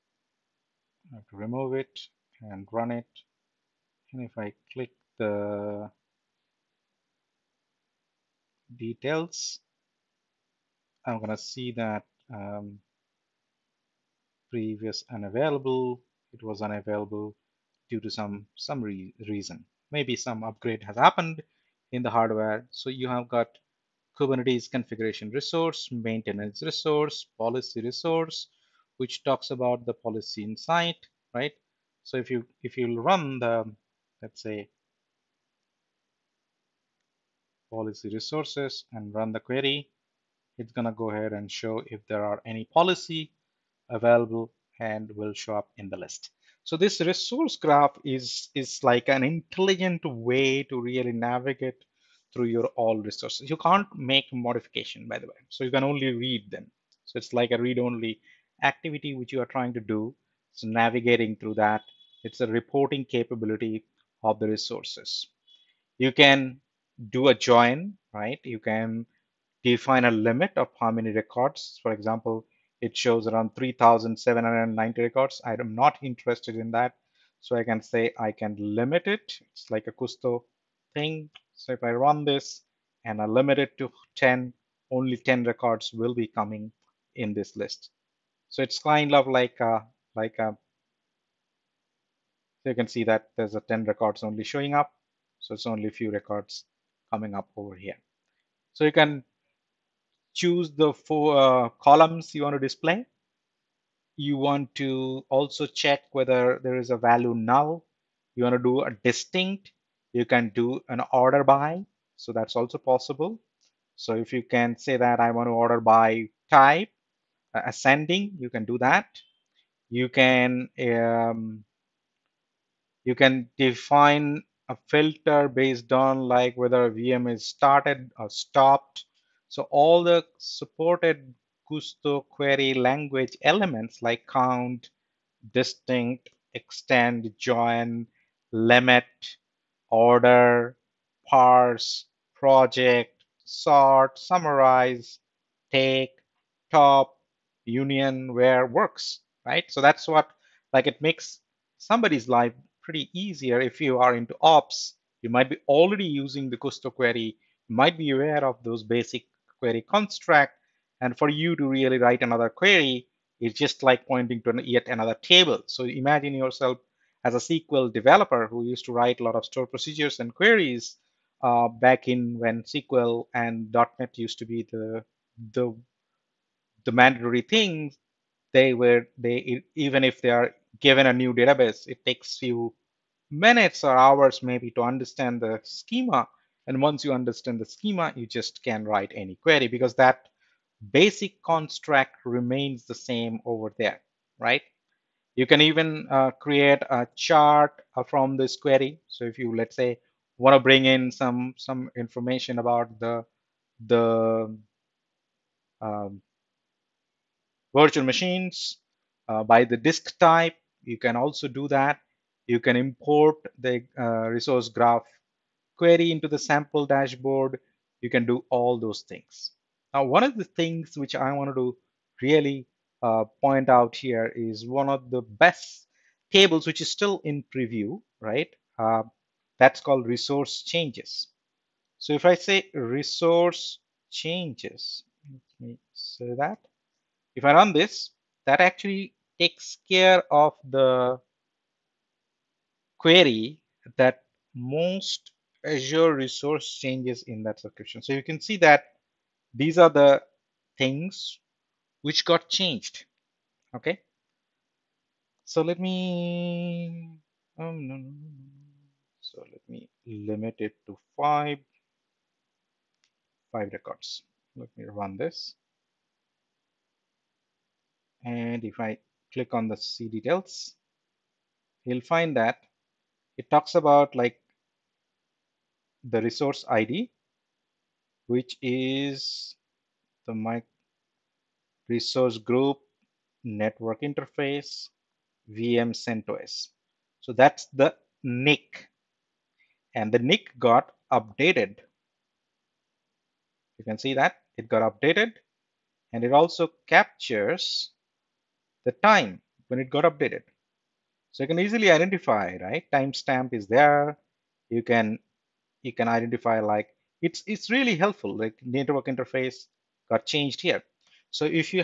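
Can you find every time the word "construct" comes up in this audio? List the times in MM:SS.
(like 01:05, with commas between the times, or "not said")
02:39, 03:11.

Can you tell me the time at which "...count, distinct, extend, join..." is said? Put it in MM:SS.
02:14.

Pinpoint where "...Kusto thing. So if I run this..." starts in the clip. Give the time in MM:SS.
01:19.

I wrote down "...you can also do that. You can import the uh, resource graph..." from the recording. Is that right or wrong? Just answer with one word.
right.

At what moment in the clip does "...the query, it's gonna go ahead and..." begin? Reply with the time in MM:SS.
00:39.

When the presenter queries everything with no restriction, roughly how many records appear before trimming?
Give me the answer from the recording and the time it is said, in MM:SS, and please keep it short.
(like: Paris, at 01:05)
3,790, at 01:13.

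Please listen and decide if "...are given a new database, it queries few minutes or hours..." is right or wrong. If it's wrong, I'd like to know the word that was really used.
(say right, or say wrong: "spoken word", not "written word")
wrong: "takes", not "queries".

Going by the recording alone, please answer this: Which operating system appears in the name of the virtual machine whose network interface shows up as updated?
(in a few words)
CentOS.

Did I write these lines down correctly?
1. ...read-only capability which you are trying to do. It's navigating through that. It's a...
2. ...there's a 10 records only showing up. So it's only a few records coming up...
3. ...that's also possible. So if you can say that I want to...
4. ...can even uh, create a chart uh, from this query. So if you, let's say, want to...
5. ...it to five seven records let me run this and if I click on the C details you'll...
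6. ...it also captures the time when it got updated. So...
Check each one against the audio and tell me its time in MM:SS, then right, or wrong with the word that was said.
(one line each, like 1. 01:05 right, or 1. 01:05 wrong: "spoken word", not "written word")
1. 00:57 wrong: "activity", not "capability"
2. 01:33 right
3. 01:52 right
4. 03:15 right
5. 04:20 wrong: "five", not "seven"
6. 04:56 right.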